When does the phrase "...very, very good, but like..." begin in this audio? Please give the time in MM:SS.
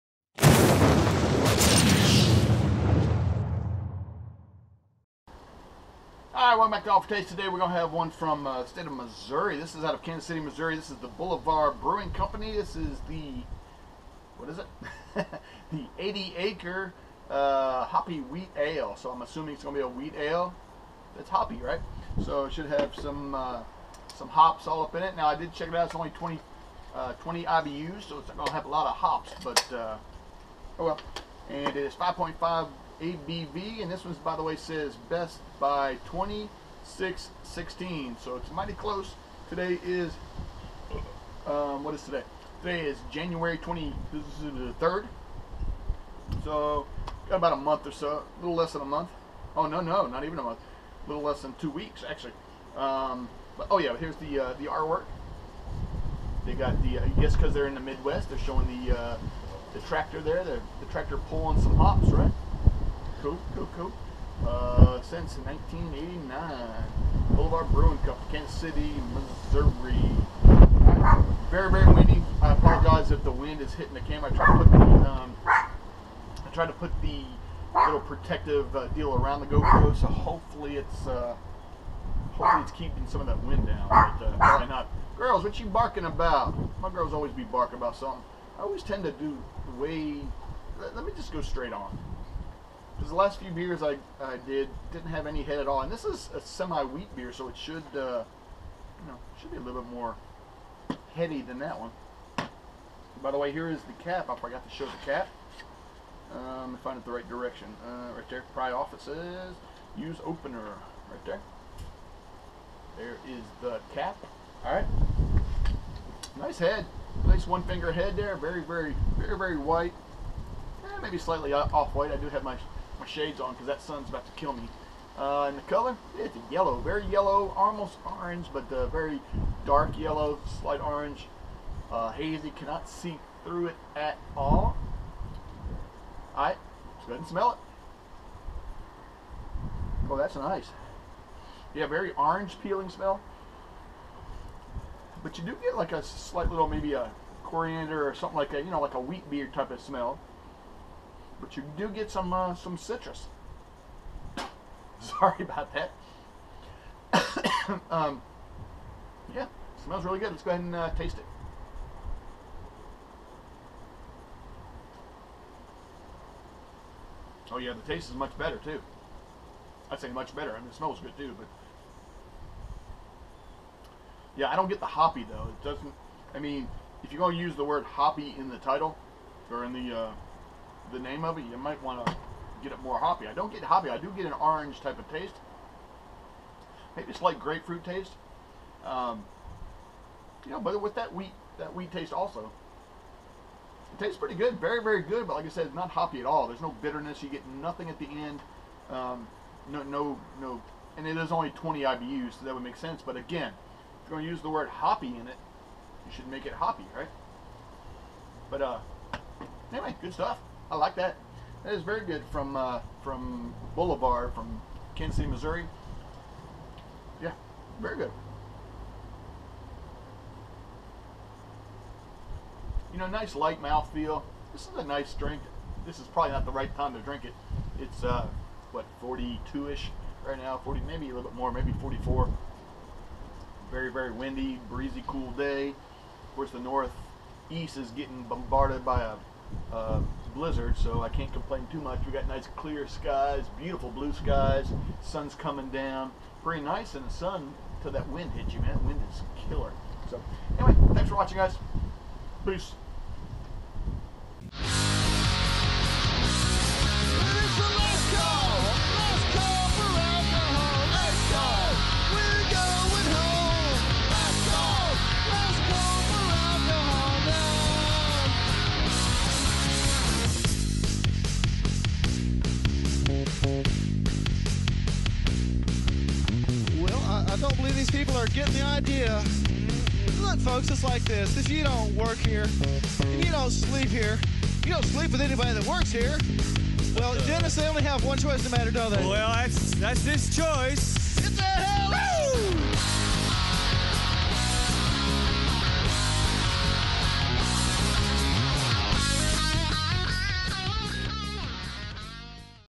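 03:14.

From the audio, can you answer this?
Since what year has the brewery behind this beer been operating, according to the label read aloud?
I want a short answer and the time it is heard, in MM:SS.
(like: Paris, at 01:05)
1989, at 01:05.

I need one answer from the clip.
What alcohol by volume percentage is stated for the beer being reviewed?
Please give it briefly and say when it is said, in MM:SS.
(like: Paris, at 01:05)
5.5, at 00:31.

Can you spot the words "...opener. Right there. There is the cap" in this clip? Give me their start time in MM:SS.
01:50.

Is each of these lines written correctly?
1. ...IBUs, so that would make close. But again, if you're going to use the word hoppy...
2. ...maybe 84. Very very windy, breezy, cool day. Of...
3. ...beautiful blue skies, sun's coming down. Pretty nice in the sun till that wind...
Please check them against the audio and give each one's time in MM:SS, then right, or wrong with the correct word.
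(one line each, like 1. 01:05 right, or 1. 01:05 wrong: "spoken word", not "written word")
1. 03:21 wrong: "sense", not "close"
2. 03:51 wrong: "44", not "84"
3. 04:03 right.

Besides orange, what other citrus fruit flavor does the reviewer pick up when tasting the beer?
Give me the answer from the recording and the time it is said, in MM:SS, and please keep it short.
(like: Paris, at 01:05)
grapefruit, at 03:07.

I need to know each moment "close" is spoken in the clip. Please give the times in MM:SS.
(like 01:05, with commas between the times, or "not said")
00:38.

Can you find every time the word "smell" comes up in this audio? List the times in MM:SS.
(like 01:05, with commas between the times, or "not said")
02:17, 02:22, 02:29, 02:39, 02:50.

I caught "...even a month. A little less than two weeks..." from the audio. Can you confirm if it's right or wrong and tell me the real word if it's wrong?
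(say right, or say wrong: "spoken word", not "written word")
right.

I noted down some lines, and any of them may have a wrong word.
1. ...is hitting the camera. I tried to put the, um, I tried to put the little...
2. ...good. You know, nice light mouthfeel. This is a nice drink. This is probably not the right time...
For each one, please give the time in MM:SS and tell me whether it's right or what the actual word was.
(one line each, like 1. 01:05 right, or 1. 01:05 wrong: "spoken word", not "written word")
1. 01:13 right
2. 03:37 right.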